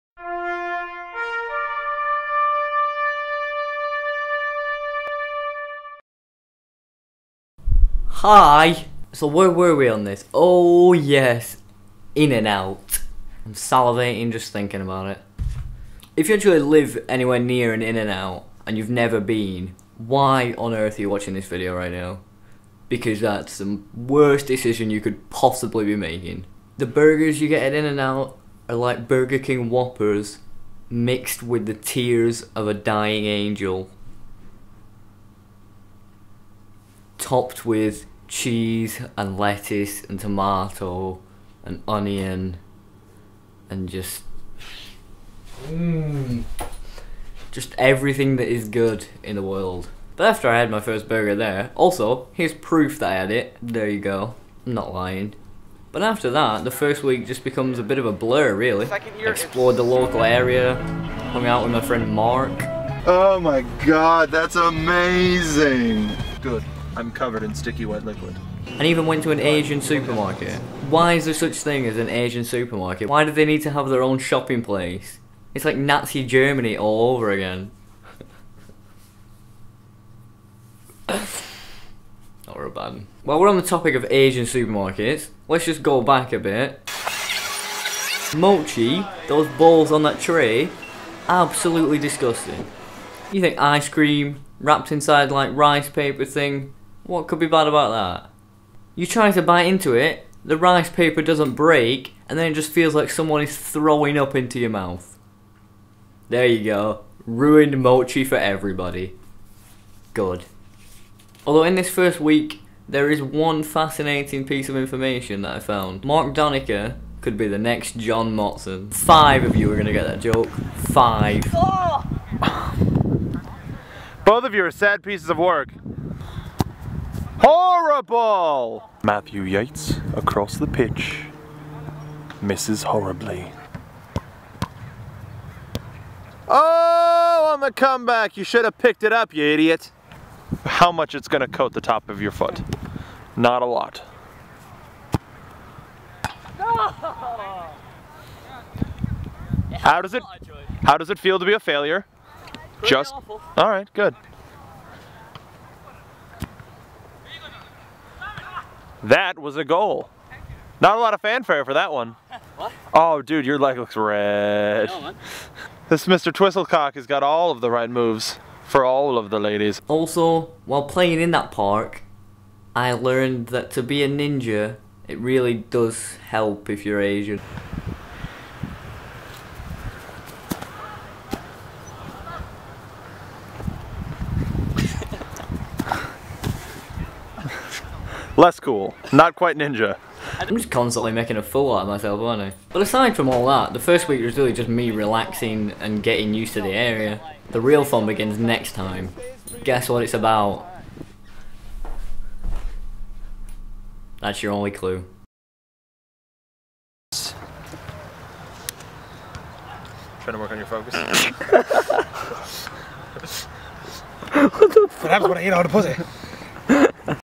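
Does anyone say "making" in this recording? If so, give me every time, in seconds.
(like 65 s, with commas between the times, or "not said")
25 s, 191 s.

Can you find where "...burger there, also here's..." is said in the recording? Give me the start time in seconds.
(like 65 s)
51 s.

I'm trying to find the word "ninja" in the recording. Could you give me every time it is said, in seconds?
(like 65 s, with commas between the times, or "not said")
174 s, 189 s.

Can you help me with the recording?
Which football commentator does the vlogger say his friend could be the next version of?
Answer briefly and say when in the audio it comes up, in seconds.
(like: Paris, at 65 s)
John Motson, at 117 s.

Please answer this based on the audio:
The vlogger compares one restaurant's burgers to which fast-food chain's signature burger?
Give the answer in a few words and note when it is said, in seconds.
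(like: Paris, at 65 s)
Burger King Whoppers, at 29 s.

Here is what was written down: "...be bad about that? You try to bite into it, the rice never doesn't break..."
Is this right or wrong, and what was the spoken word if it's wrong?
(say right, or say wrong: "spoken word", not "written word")
wrong: "paper", not "never".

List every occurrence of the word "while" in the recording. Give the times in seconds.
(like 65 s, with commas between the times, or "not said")
83 s, 170 s.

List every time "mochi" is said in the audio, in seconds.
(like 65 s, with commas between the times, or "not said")
88 s, 107 s.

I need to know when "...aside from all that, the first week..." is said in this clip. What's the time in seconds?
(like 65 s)
192 s.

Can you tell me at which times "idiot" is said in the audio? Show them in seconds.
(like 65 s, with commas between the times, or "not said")
139 s.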